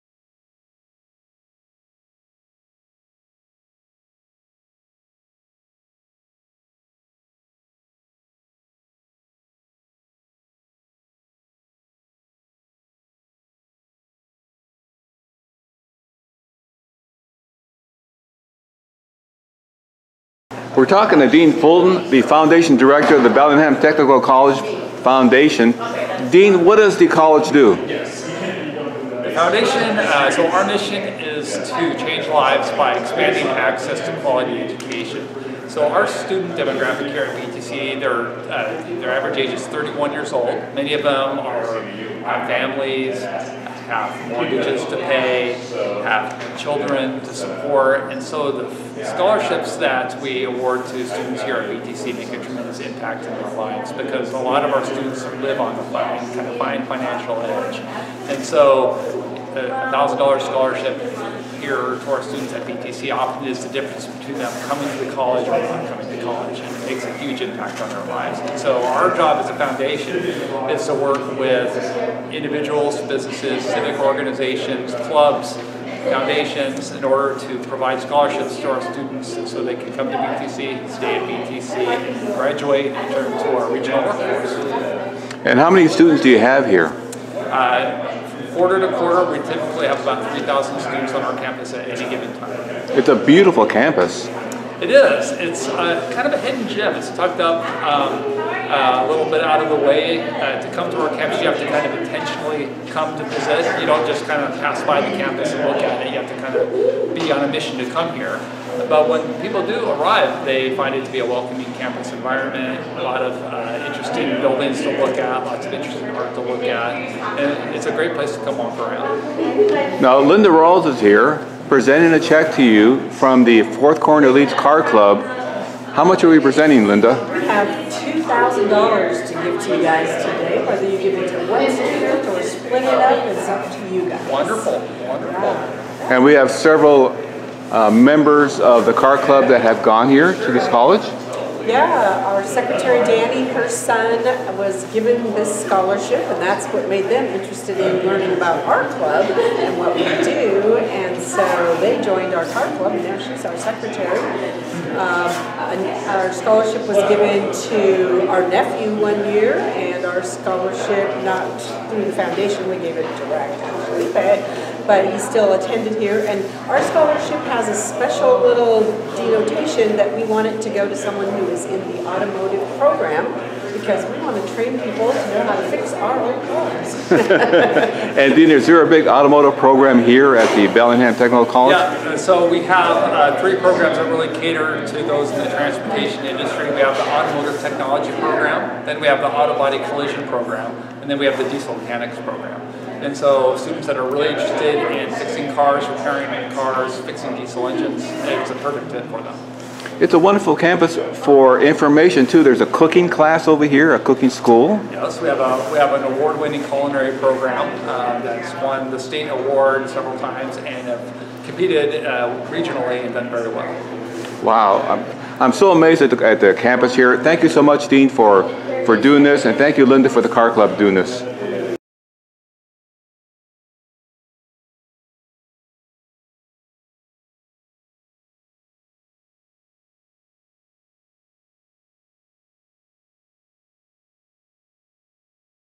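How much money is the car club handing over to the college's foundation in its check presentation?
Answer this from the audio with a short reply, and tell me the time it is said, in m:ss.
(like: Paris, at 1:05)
$2,000, at 2:07.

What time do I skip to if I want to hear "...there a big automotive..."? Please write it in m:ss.
2:58.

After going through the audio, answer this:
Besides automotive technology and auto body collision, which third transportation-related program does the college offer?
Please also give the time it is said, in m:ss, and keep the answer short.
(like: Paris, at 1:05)
Diesel mechanics, at 3:11.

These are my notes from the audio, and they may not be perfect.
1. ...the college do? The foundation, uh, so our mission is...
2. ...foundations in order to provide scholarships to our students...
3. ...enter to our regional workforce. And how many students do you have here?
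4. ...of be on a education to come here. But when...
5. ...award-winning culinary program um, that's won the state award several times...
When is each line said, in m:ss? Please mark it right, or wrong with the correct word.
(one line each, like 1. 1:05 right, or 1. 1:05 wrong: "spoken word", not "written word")
1. 0:26 right
2. 1:16 right
3. 1:22 right
4. 1:46 wrong: "mission", not "education"
5. 3:26 right.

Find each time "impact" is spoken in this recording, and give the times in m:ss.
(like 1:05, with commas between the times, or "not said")
0:52, 1:07.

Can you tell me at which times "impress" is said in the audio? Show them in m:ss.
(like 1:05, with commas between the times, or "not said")
not said.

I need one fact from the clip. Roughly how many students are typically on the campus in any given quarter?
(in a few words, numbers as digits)
3,000.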